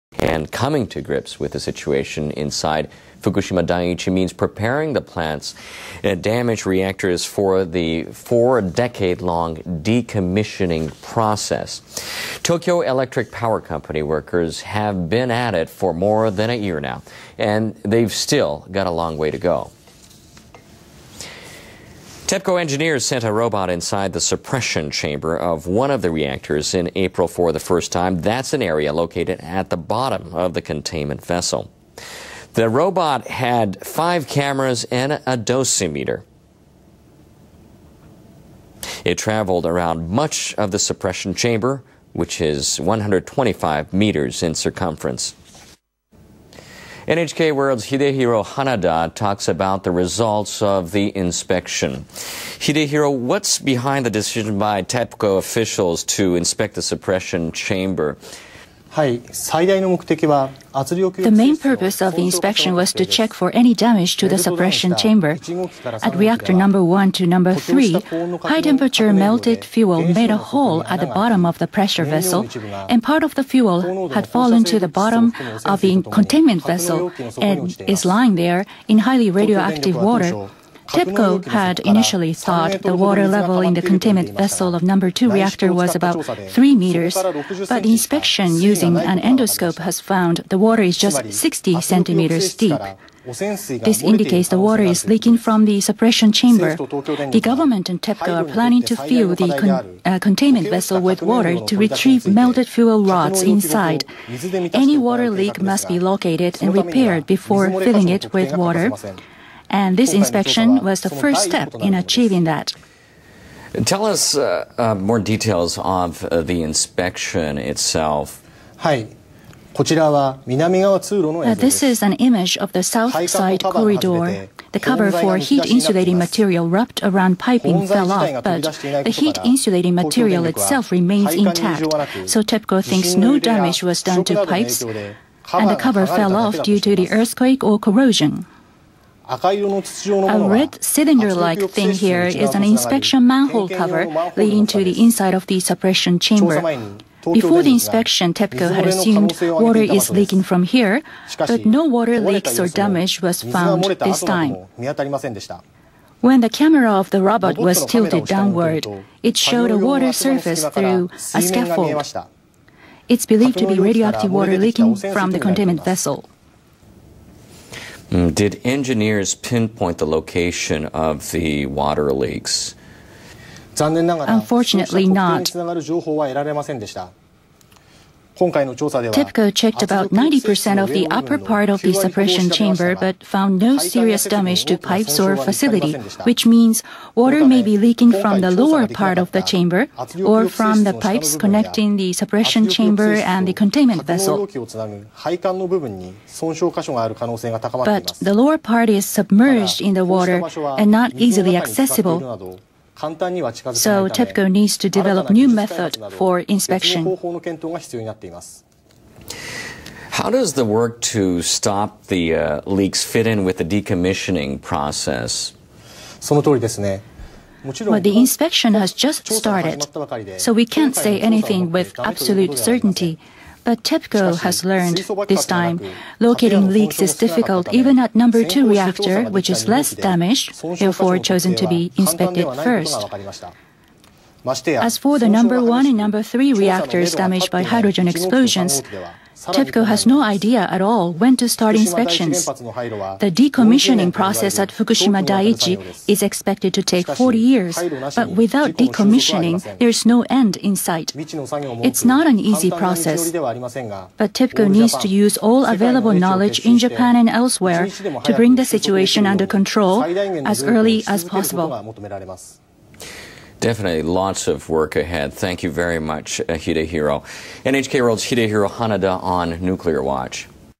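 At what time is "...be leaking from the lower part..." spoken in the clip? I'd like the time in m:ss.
3:07.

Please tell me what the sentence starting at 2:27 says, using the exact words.
Before the inspection, TEPCO had assumed water is leaking from here, but no water leaks or damage was found this time.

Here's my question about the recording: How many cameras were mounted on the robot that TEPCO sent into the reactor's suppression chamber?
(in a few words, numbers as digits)
5.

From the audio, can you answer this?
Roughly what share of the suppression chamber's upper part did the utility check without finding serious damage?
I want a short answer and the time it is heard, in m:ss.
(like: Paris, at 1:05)
90%, at 3:00.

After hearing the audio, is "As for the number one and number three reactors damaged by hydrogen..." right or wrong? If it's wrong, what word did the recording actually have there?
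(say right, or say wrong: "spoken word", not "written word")
right.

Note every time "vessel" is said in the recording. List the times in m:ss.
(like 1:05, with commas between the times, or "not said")
0:31, 1:12, 1:16, 1:24, 1:40, 2:45, 3:14.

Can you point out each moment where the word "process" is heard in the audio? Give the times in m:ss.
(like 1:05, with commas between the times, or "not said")
0:11, 3:34, 4:04, 4:12.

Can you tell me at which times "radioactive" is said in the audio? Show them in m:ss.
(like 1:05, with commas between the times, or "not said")
1:19, 2:43.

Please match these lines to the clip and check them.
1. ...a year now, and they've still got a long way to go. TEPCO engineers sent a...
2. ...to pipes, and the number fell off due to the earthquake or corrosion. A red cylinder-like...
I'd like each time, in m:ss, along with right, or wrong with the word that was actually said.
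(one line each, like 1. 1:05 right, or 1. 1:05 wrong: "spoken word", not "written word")
1. 0:16 right
2. 2:14 wrong: "cover", not "number".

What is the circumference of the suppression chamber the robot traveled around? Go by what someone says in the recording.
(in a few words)
125 meters.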